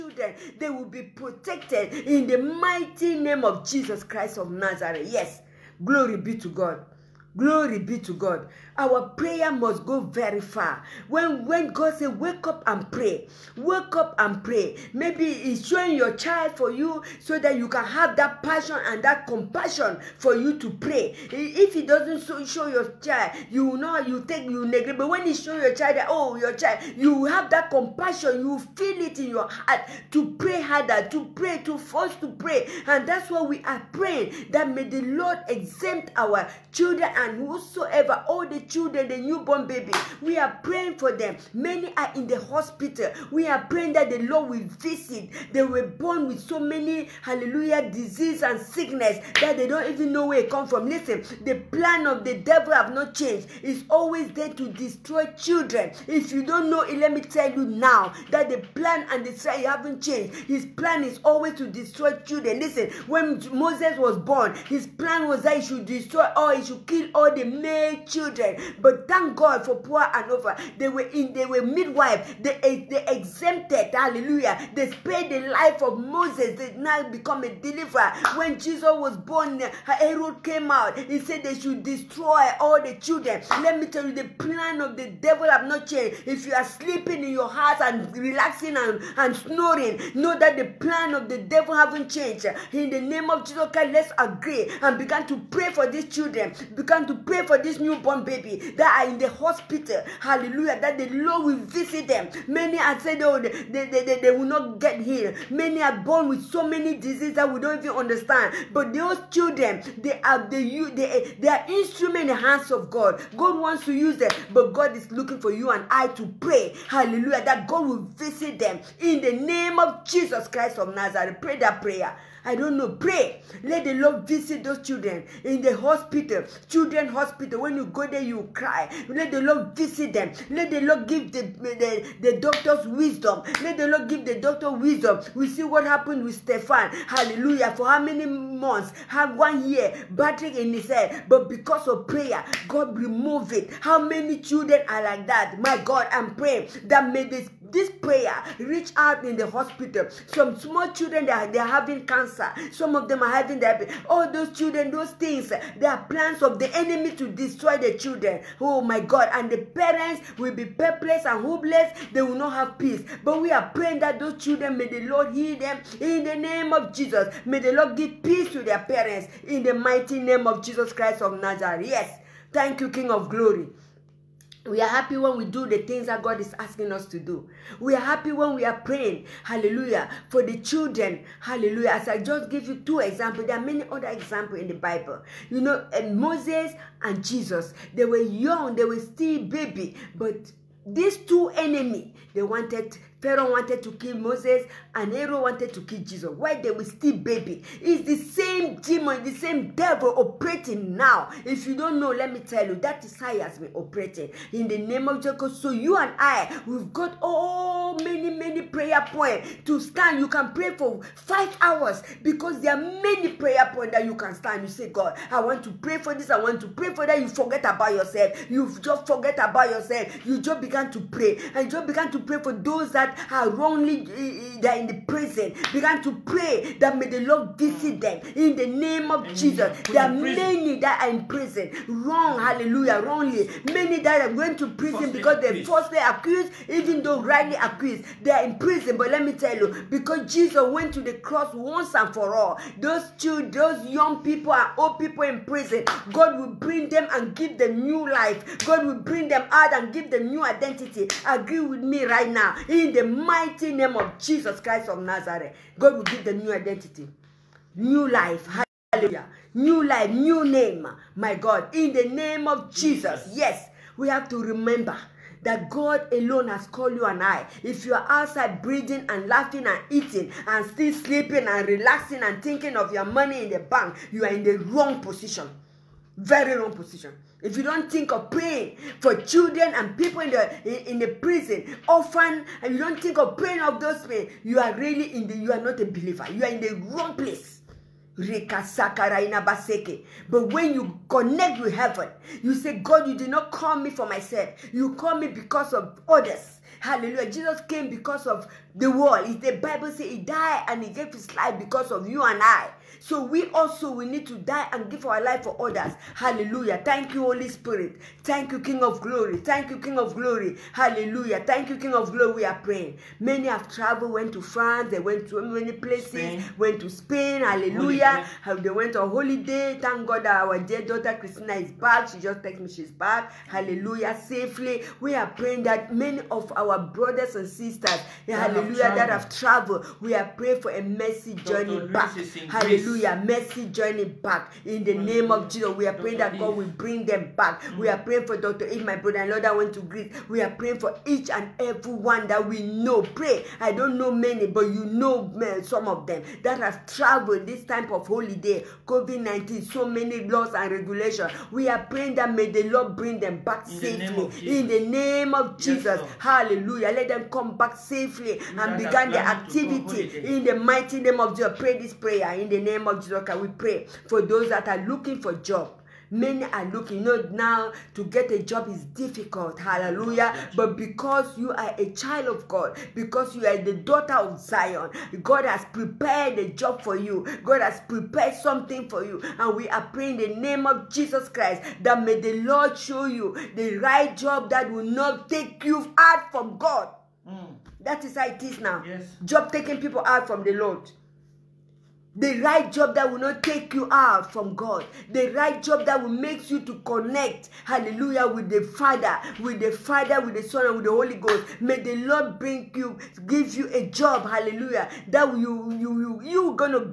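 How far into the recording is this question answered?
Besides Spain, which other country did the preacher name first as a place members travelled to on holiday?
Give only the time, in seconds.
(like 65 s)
314 s.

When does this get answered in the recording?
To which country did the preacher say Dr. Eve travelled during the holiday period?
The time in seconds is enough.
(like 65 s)
339 s.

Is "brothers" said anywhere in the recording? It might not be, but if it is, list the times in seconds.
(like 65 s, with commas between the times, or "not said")
326 s, 338 s.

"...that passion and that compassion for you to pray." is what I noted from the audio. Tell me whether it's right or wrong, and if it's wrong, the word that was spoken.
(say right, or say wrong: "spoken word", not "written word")
right.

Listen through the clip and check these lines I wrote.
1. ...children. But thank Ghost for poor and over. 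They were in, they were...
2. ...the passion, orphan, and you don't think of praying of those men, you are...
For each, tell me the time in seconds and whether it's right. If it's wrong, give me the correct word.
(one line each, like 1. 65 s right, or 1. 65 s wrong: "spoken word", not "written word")
1. 68 s wrong: "God", not "Ghost"
2. 280 s wrong: "prison", not "passion".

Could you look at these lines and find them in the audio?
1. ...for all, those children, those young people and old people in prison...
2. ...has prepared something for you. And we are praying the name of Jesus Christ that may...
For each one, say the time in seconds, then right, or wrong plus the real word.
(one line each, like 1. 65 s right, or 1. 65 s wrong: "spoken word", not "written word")
1. 242 s right
2. 377 s right.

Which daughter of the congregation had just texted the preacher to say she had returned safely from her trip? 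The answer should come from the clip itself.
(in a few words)
Christina.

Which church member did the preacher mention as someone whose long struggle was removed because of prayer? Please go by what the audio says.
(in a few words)
Stefan.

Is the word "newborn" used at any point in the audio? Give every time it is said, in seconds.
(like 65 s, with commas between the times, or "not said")
39 s, 97 s.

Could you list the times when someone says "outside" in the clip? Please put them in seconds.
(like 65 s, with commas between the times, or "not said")
268 s.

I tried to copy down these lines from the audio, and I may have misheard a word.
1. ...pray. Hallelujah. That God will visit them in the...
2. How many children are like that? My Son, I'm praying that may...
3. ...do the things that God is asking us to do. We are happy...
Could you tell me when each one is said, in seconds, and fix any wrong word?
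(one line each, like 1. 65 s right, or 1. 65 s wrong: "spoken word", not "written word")
1. 116 s right
2. 143 s wrong: "God", not "Son"
3. 175 s right.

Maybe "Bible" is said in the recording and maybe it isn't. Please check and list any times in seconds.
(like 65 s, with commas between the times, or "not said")
184 s, 299 s.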